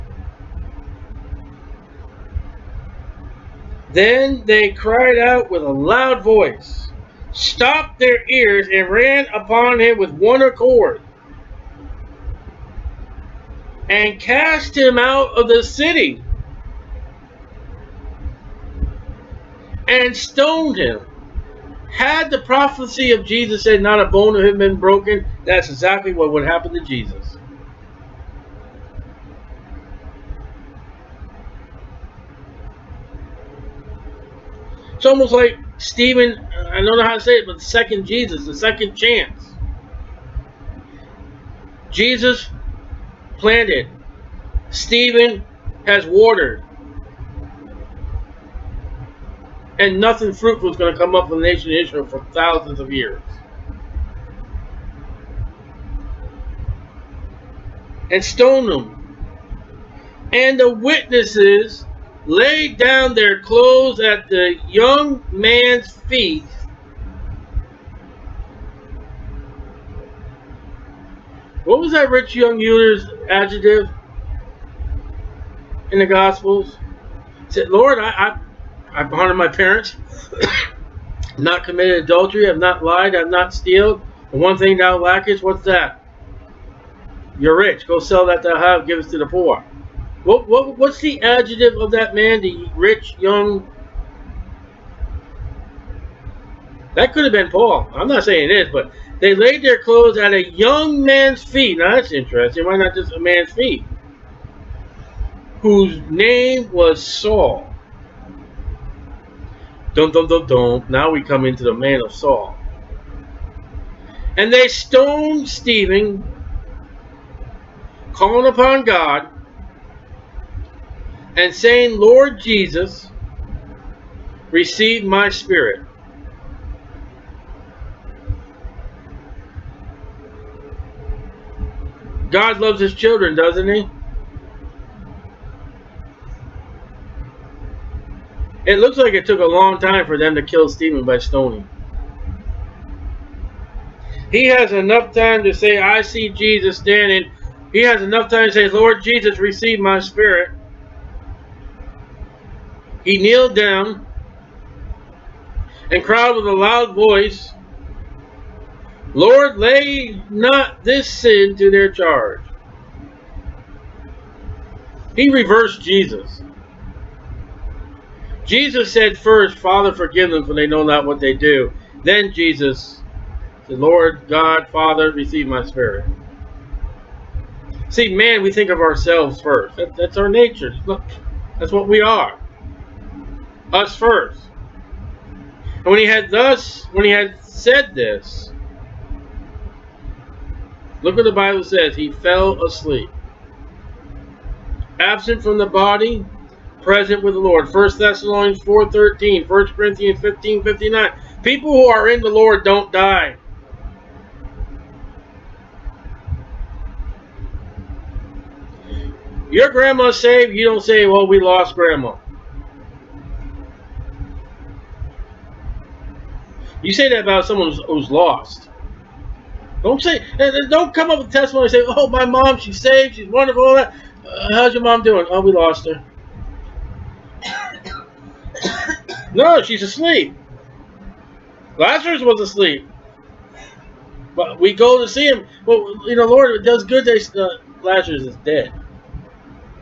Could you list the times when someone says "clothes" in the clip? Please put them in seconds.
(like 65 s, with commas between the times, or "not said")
63 s, 99 s.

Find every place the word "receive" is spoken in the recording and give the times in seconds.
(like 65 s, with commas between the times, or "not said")
124 s, 149 s, 175 s.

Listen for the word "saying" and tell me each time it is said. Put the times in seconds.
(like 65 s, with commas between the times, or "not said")
98 s, 121 s.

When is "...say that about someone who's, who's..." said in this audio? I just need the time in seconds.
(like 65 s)
216 s.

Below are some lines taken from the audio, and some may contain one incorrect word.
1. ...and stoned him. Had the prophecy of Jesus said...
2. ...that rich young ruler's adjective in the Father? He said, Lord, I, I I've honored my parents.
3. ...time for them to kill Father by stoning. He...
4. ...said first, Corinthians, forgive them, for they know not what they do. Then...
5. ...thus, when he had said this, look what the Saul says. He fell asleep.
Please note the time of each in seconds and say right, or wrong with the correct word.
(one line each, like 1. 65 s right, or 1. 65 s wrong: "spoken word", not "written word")
1. 19 s right
2. 71 s wrong: "Gospels", not "Father"
3. 139 s wrong: "Stephen", not "Father"
4. 168 s wrong: "Father", not "Corinthians"
5. 186 s wrong: "Bible", not "Saul".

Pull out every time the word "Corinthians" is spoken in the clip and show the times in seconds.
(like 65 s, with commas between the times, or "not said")
199 s.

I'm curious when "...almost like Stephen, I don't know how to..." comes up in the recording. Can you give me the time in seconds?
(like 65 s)
35 s.